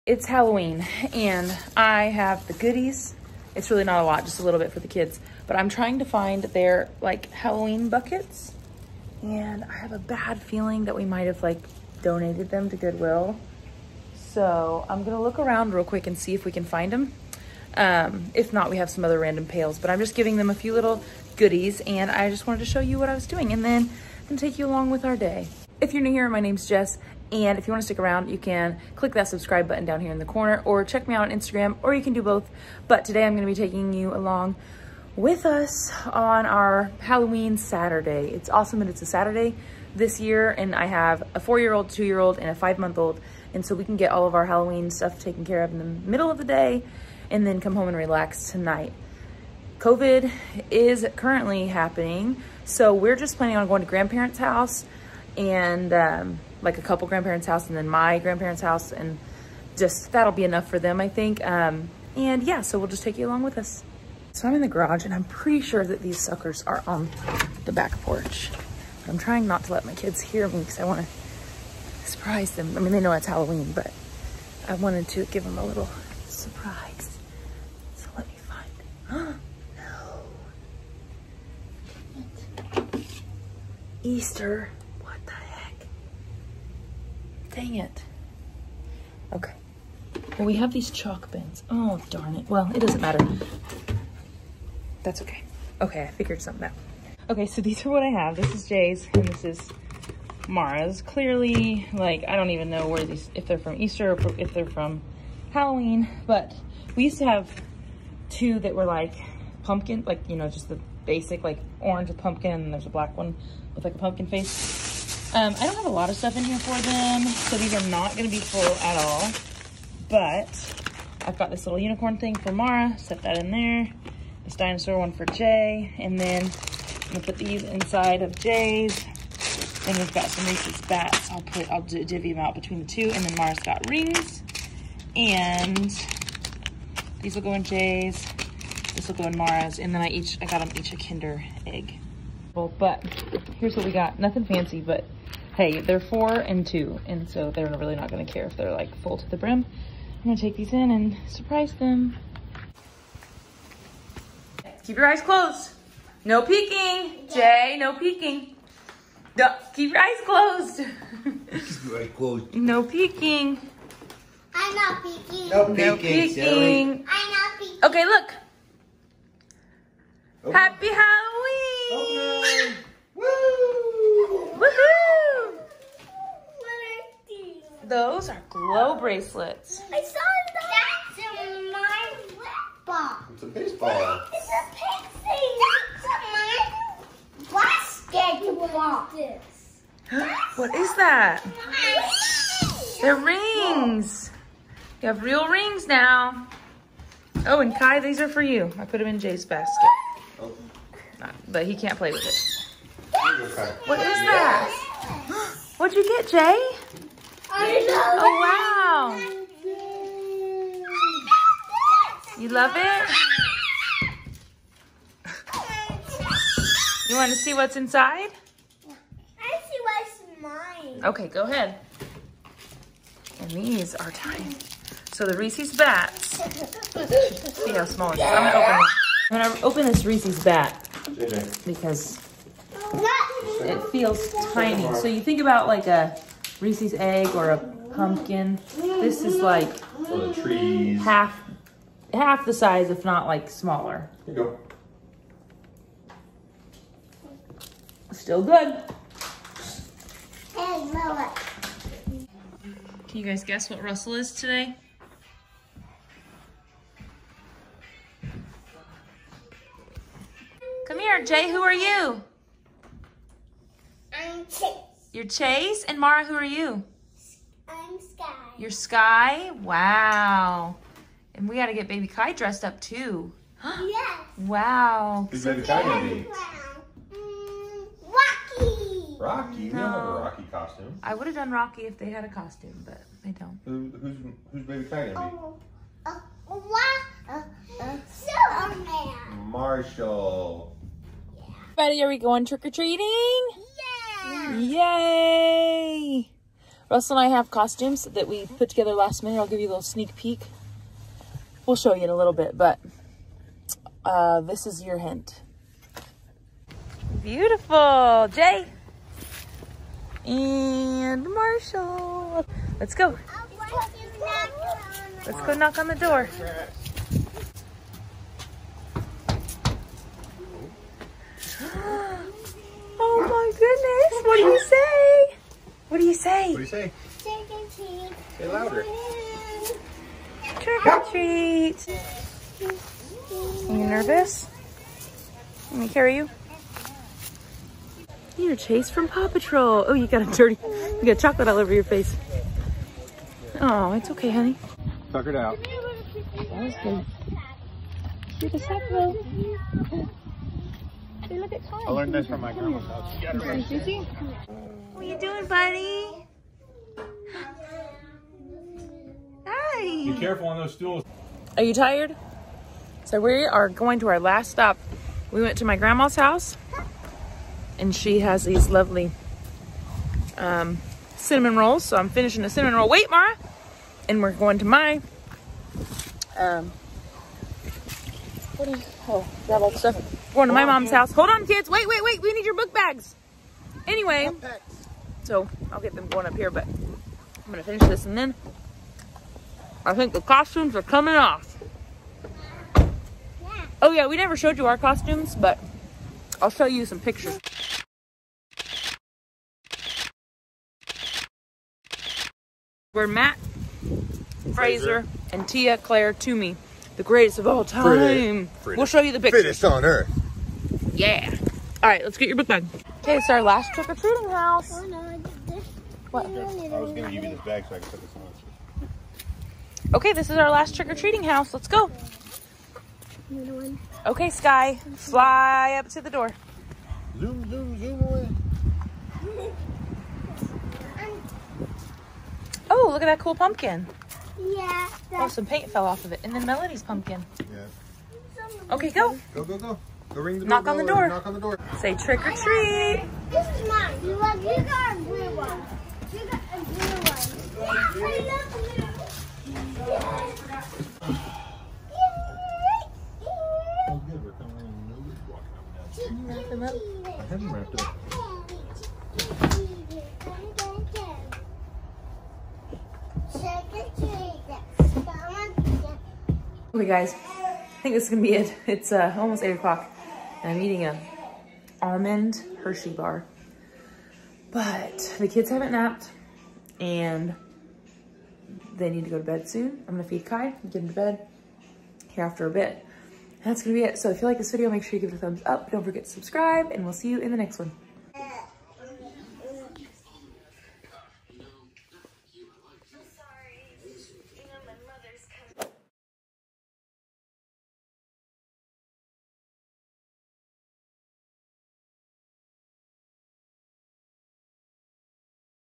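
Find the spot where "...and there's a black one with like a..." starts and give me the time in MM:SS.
01:52.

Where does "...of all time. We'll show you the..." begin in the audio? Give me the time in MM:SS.
06:47.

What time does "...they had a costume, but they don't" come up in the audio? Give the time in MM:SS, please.
04:41.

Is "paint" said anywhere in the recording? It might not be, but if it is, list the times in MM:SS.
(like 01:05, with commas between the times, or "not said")
07:15.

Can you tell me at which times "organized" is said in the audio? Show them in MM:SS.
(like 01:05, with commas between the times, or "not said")
not said.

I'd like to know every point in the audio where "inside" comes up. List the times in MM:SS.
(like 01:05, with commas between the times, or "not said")
02:07, 03:37.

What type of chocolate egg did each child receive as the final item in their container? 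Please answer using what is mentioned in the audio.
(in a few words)
Kinder egg.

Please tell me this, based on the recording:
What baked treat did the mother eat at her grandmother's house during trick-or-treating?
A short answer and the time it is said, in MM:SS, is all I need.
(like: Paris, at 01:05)
cinnamon rolls, at 06:11.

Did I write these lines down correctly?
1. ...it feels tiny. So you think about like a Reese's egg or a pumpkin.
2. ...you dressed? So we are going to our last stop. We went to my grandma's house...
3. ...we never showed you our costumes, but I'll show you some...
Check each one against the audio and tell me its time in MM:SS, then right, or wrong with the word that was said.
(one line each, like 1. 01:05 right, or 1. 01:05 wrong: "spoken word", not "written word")
1. 03:53 right
2. 06:01 wrong: "tired", not "dressed"
3. 06:34 right.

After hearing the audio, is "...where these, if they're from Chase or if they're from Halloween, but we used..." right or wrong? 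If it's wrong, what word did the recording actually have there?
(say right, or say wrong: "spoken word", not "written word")
wrong: "Easter", not "Chase".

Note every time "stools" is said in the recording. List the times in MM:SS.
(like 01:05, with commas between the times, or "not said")
06:00.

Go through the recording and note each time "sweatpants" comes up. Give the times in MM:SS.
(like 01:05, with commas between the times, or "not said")
not said.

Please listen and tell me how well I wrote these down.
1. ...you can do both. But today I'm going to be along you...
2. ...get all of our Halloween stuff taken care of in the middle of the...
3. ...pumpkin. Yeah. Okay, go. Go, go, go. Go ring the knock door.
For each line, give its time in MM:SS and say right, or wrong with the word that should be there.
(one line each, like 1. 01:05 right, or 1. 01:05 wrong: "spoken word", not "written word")
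1. 00:31 wrong: "taking", not "along"
2. 00:43 right
3. 07:16 right.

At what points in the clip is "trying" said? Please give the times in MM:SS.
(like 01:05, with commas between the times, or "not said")
00:05, 01:09.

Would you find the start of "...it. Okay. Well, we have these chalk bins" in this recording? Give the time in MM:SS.
01:27.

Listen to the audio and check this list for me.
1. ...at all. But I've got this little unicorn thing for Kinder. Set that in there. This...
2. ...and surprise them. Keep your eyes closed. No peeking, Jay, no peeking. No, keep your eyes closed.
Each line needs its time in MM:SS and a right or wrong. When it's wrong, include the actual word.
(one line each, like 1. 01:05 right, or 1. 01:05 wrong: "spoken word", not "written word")
1. 01:58 wrong: "Mara", not "Kinder"
2. 02:30 right.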